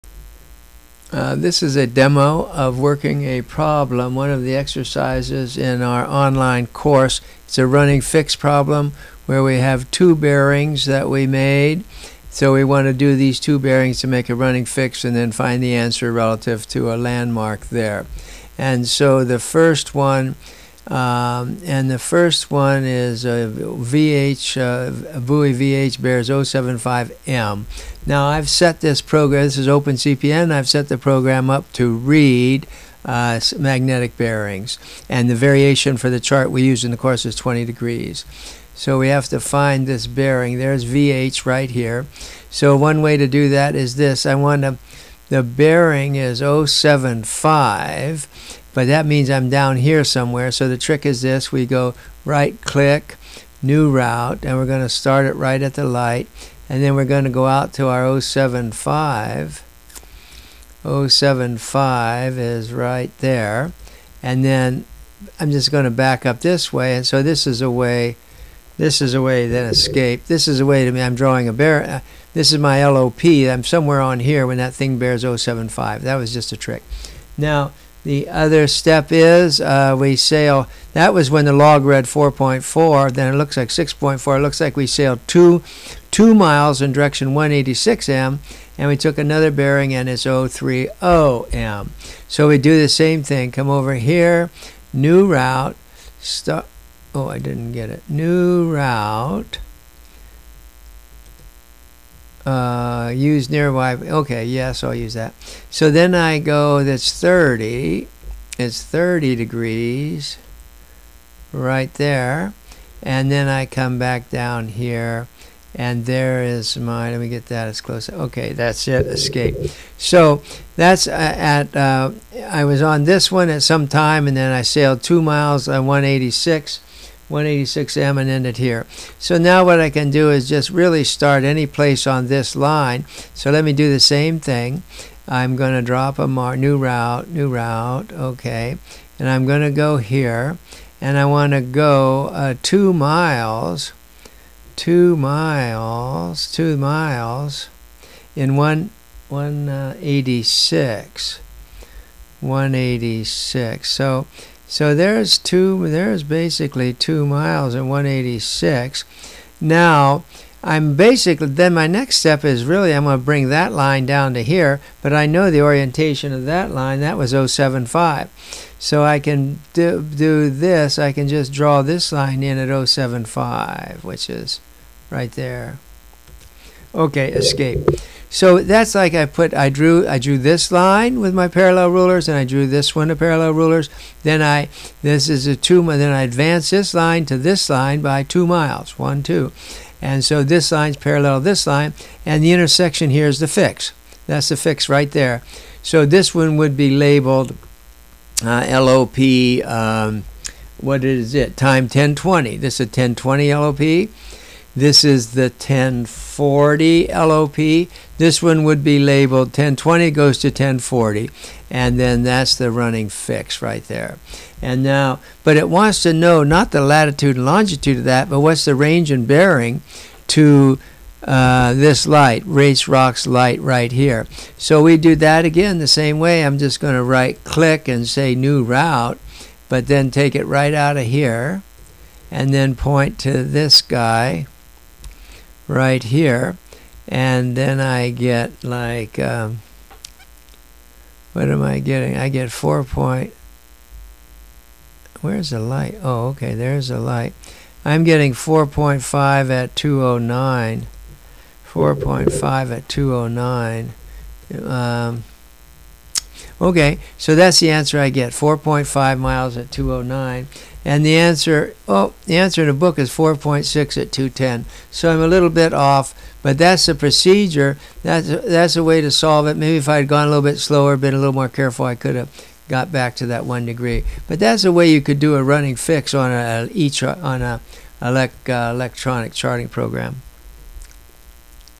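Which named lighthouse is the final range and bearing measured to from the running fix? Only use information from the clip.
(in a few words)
Race Rocks light.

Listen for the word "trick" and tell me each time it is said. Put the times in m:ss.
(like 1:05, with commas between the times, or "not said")
0:50, 1:16.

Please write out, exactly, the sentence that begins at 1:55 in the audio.
And there is my, let me get that as close.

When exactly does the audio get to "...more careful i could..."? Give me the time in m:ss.
4:31.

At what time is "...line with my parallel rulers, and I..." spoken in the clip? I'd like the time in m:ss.
3:00.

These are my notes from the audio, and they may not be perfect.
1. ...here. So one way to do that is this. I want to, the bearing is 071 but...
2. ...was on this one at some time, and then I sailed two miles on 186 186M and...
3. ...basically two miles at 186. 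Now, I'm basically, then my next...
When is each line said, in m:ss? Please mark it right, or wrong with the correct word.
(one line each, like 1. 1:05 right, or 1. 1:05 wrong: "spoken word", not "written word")
1. 0:41 wrong: "075", not "071"
2. 2:02 right
3. 2:36 right.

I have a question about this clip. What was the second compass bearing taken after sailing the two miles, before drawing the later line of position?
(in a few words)
030M.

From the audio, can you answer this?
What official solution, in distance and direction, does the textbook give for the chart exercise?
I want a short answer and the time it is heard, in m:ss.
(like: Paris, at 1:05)
4.6 at 210, at 4:23.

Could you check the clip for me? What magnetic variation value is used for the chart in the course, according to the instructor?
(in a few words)
20 degrees.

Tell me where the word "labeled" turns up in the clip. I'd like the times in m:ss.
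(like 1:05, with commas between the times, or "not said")
3:16, 3:28.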